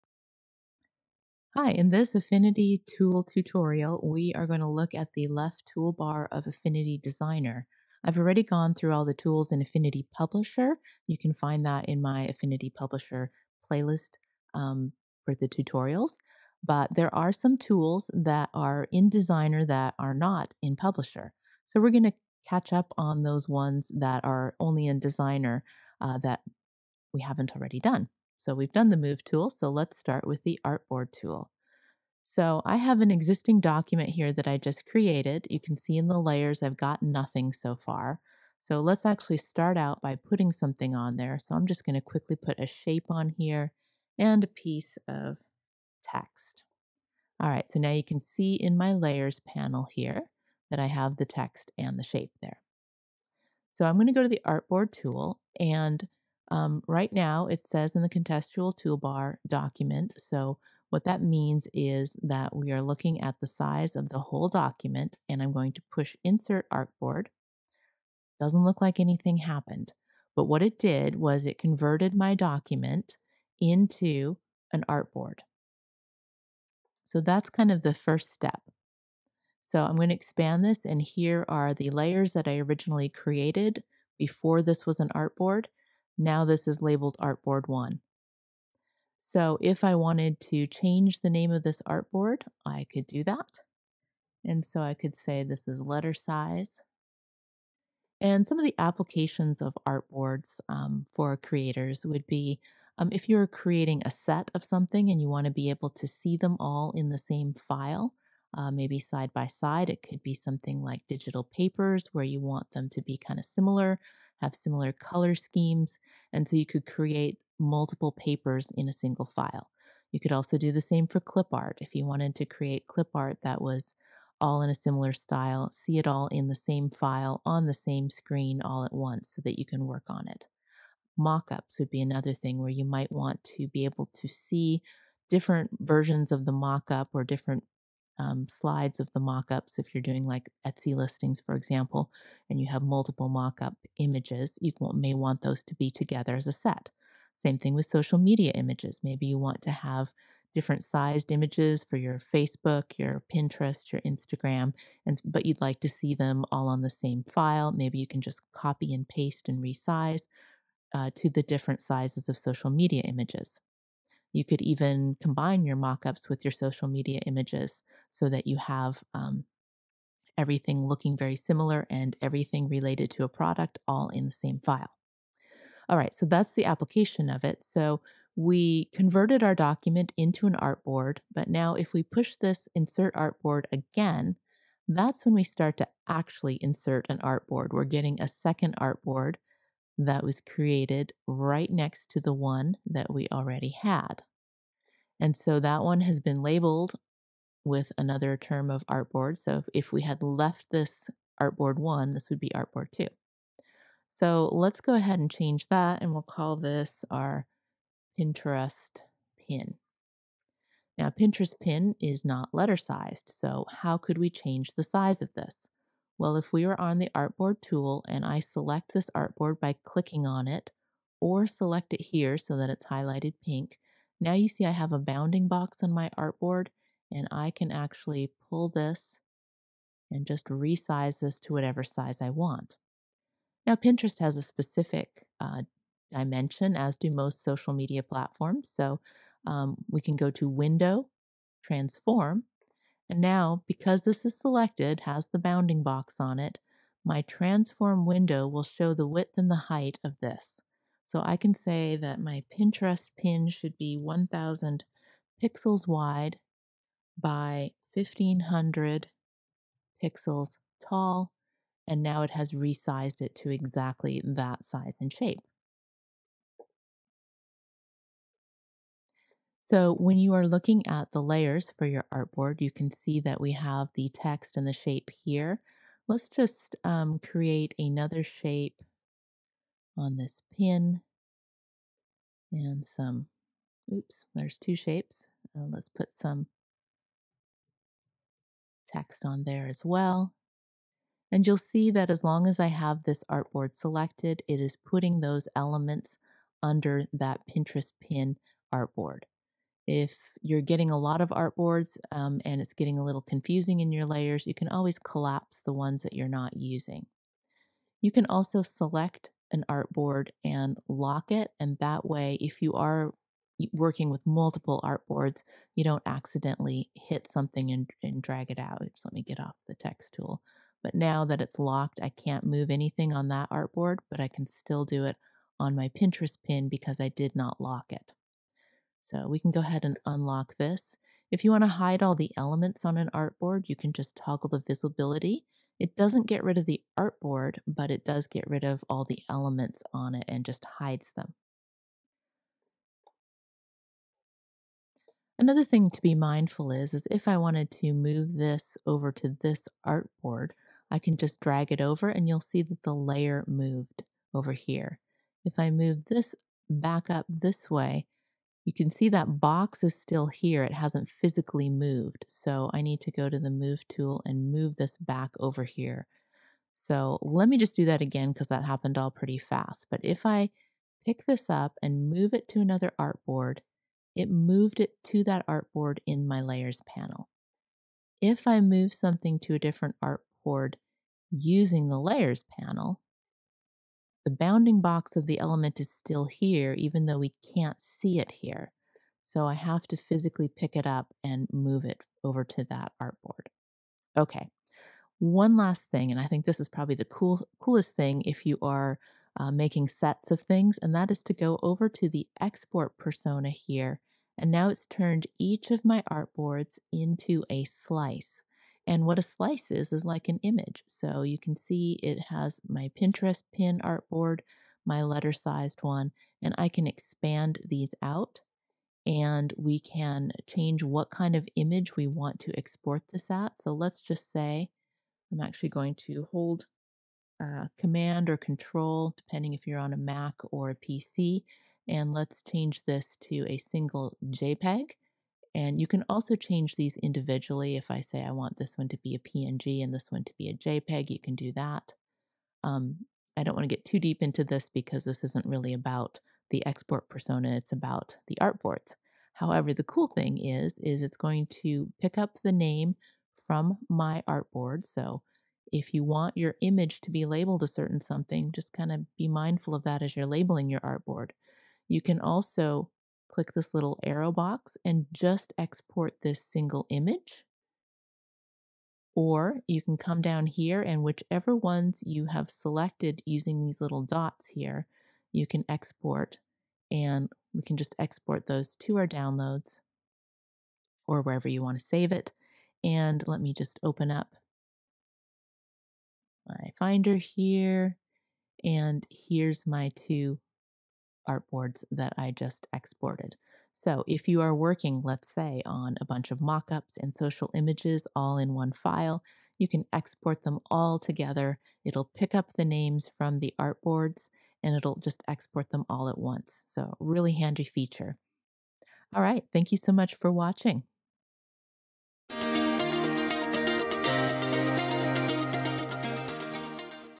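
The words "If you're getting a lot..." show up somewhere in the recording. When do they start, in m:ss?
4:59.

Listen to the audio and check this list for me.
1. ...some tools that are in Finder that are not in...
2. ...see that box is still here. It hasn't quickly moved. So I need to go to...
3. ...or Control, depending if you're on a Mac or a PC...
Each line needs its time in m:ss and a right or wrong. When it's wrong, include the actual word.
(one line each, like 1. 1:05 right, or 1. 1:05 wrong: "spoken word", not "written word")
1. 0:17 wrong: "Designer", not "Finder"
2. 5:58 wrong: "physically", not "quickly"
3. 7:08 right.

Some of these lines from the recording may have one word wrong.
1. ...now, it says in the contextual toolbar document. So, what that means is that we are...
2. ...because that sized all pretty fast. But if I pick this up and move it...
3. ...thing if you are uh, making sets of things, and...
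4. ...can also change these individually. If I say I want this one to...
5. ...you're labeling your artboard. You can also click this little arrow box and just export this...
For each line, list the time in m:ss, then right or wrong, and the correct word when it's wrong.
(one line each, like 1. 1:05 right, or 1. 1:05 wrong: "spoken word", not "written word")
1. 0:57 right
2. 6:08 wrong: "happened", not "sized"
3. 6:37 right
4. 7:15 right
5. 7:40 right.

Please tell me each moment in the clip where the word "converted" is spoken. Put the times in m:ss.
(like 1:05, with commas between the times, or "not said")
1:11, 2:58.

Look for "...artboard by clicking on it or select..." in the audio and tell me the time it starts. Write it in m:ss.
3:39.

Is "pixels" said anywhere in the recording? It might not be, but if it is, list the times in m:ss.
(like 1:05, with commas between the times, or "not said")
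4:15, 4:20.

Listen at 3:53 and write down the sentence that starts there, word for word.
Now, Pinterest has a specific uh, dimension, as do most social media platforms.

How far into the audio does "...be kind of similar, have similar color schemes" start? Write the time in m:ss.
1:53.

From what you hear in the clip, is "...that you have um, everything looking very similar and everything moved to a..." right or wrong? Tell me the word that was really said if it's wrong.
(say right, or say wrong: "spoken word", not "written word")
wrong: "related", not "moved".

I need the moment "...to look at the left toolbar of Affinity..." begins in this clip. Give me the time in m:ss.
0:04.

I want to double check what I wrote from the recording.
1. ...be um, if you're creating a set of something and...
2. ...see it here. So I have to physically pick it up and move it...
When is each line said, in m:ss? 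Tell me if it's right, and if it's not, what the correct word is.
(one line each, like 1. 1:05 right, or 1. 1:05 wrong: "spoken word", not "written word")
1. 1:42 right
2. 6:27 right.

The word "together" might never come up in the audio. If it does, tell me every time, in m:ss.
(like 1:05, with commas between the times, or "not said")
2:25, 8:20.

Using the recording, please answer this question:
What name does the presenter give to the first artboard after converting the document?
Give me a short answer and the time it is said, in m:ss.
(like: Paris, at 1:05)
letter size, at 1:35.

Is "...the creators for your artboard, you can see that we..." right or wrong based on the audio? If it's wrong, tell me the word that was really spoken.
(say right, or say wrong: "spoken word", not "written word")
wrong: "layers", not "creators".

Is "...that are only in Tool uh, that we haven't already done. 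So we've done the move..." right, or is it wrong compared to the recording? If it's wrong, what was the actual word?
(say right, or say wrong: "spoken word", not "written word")
wrong: "Designer", not "Tool".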